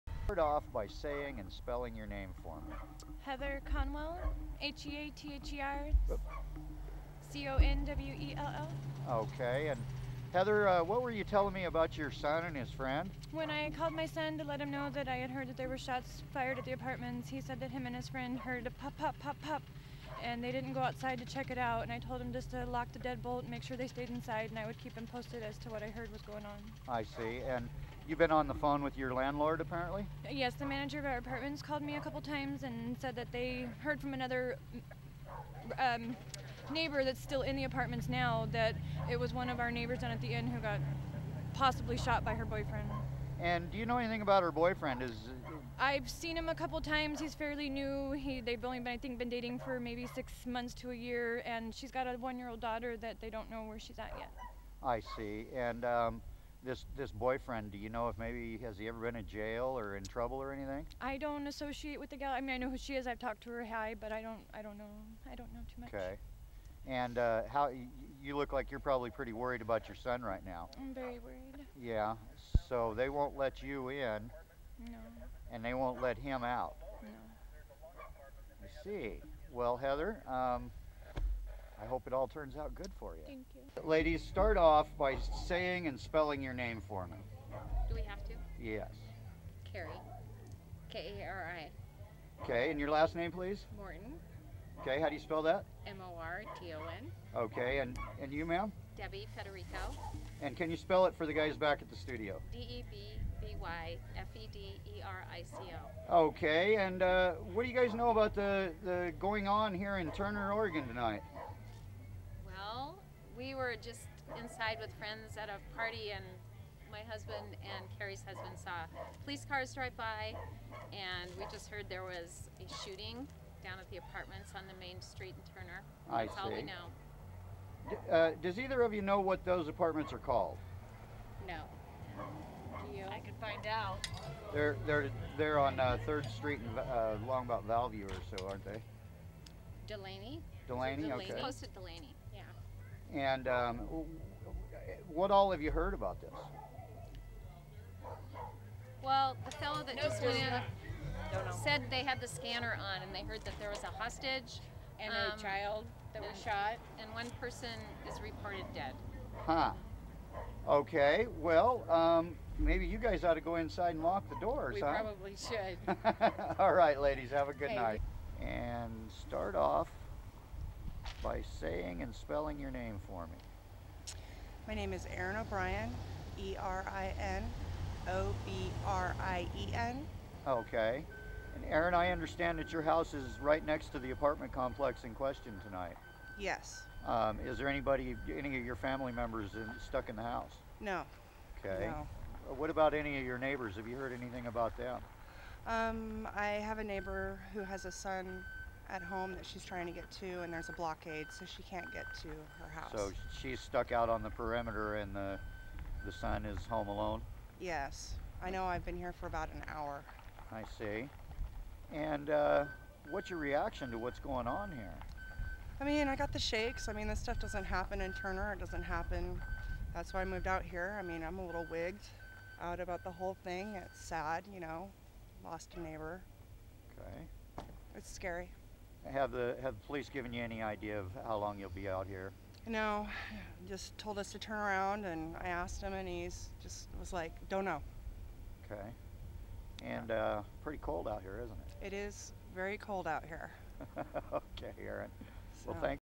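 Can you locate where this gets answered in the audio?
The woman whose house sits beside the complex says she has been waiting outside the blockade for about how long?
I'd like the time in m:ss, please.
3:29.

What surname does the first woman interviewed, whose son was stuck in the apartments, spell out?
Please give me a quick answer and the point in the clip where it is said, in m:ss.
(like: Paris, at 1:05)
Conwell, at 0:03.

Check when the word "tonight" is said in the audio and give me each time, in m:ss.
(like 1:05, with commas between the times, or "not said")
1:50, 3:05.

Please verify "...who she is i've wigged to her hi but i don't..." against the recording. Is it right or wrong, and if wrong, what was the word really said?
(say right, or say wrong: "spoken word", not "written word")
wrong: "talked", not "wigged".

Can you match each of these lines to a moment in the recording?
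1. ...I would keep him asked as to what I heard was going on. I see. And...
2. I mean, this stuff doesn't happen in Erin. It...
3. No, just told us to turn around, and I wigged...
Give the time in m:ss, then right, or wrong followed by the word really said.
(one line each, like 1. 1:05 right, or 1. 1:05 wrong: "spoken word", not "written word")
1. 0:24 wrong: "posted", not "asked"
2. 3:36 wrong: "Turner", not "Erin"
3. 3:52 wrong: "asked", not "wigged".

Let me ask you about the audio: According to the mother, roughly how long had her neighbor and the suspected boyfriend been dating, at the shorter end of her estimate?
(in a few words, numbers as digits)
6 months.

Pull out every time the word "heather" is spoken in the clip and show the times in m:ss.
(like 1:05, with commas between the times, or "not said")
0:03, 0:10, 1:19.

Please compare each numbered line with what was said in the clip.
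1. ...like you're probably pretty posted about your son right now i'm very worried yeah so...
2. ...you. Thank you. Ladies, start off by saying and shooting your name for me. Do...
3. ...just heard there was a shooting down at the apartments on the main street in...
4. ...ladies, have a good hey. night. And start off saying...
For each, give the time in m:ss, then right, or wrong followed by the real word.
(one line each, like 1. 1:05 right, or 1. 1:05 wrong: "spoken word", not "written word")
1. 1:08 wrong: "worried", not "posted"
2. 1:23 wrong: "spelling", not "shooting"
3. 2:01 right
4. 2:47 right.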